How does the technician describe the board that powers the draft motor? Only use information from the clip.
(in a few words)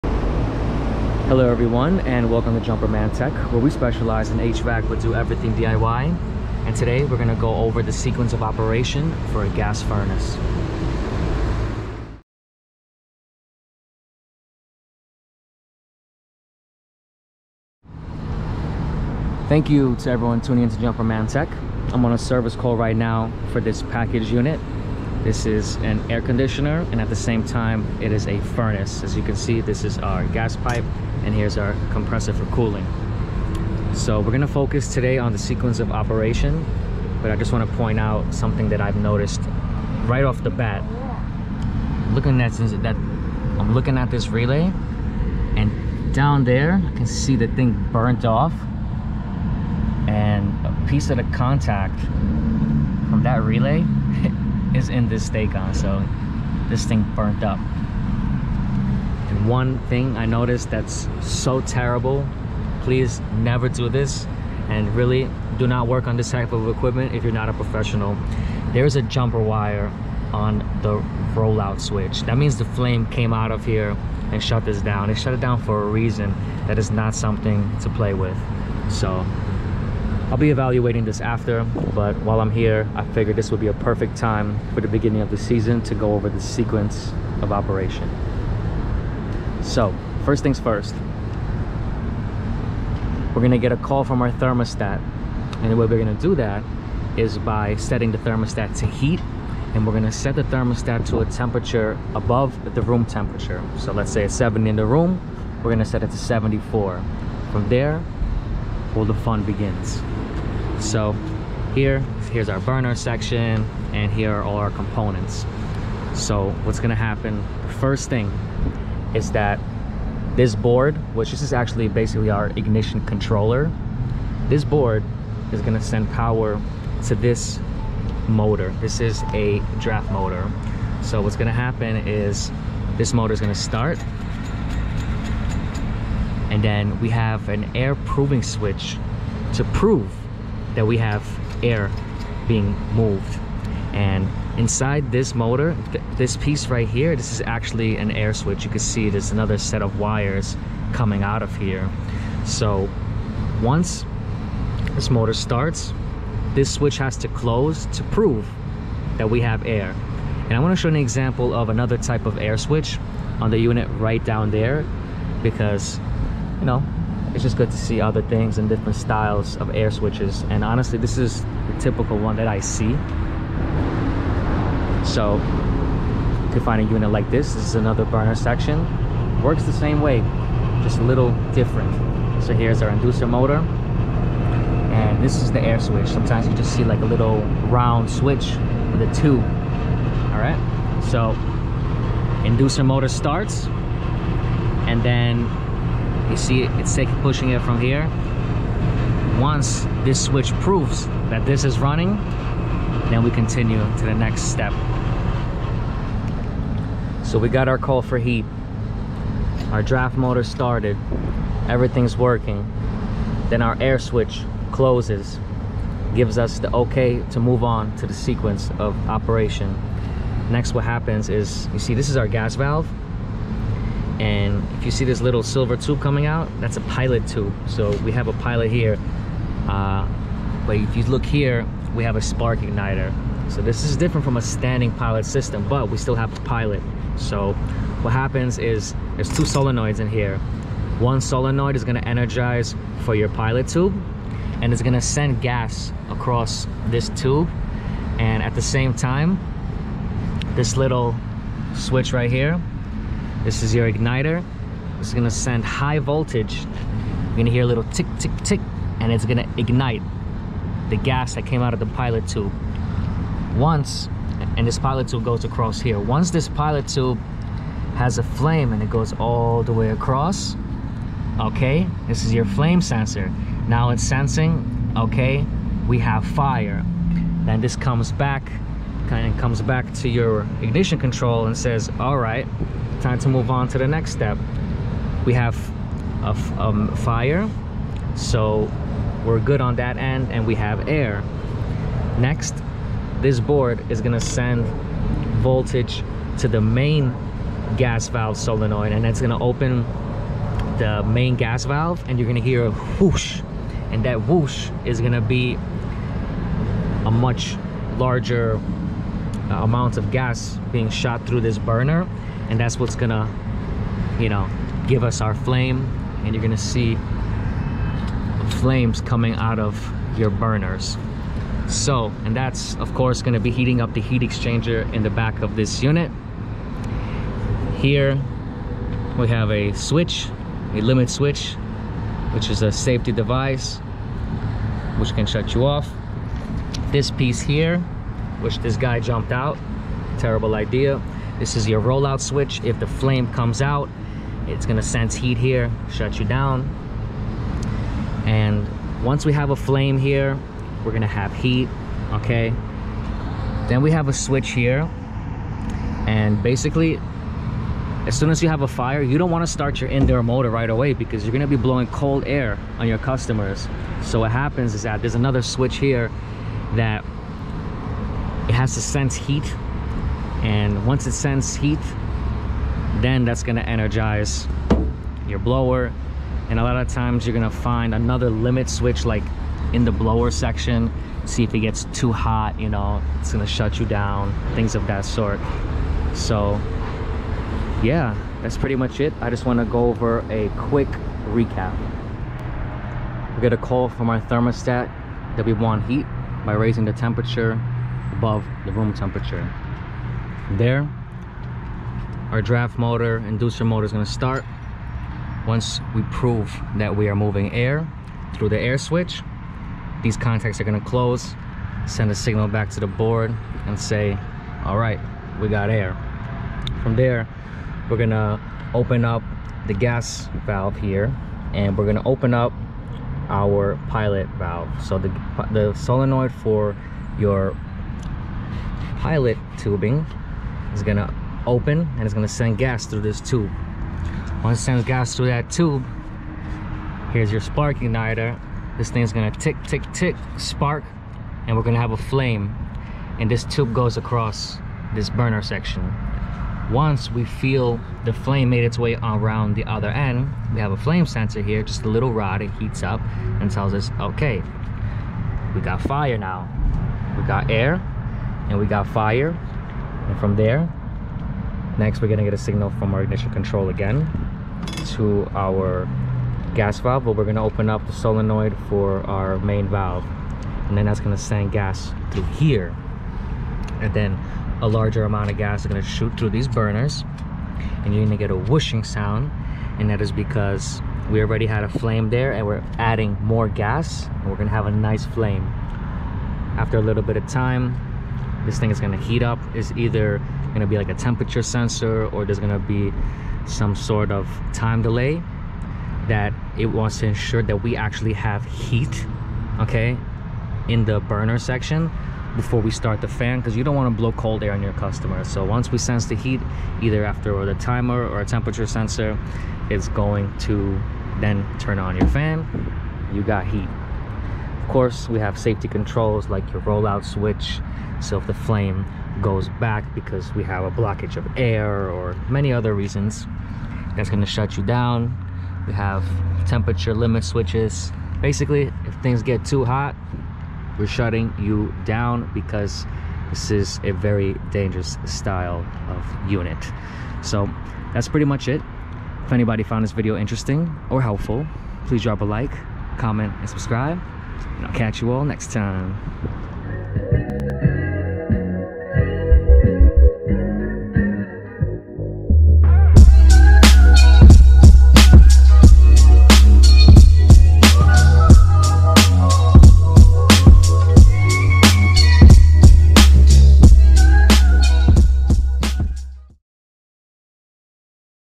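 ignition controller.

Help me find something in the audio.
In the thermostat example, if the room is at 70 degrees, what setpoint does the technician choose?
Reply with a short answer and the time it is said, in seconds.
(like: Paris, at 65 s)
74, at 106 s.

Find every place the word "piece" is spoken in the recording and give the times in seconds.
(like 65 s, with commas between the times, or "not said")
50 s, 146 s, 337 s.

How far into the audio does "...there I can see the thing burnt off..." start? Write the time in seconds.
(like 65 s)
46 s.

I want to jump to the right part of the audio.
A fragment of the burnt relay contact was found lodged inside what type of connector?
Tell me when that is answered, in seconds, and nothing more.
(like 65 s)
55 s.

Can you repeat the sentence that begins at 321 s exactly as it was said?
So, and that's of course gonna be heating up the heat exchanger in the back of this unit.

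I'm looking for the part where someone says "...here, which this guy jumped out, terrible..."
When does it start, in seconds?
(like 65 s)
337 s.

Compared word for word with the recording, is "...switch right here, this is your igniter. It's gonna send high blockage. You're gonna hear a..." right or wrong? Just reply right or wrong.
wrong.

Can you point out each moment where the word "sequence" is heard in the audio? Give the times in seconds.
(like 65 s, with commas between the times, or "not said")
7 s, 35 s, 86 s, 218 s.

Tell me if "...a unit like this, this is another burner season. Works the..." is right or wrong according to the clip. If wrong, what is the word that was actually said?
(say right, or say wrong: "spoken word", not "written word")
wrong: "section", not "season".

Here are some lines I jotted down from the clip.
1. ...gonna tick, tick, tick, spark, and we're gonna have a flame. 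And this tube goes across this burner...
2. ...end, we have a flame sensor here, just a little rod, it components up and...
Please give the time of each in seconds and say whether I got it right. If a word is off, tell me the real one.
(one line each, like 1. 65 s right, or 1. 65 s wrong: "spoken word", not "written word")
1. 439 s right
2. 449 s wrong: "heats", not "components".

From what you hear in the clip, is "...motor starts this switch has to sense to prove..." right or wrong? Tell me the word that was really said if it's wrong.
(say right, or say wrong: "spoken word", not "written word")
wrong: "close", not "sense".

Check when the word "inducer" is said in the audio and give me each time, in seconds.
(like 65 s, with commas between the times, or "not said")
182 s, 192 s, 403 s.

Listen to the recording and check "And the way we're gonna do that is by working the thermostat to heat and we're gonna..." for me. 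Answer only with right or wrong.
wrong.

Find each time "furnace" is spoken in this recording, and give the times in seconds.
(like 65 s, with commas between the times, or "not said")
9 s, 28 s.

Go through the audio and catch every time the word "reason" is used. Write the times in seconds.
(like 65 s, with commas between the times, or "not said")
75 s, 522 s.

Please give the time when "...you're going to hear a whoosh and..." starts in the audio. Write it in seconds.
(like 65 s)
302 s.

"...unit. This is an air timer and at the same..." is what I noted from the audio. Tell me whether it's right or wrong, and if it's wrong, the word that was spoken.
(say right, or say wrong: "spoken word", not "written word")
wrong: "conditioner", not "timer".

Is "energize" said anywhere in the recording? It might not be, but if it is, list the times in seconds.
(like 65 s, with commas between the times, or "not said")
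242 s, 373 s.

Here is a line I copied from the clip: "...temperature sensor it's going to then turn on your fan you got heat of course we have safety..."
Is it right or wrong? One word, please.
right.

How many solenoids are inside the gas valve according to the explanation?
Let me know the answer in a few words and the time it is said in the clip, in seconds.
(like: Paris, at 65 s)
2, at 239 s.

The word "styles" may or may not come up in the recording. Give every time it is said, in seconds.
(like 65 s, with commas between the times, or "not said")
168 s, 535 s.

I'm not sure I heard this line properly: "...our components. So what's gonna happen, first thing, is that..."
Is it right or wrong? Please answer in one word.
right.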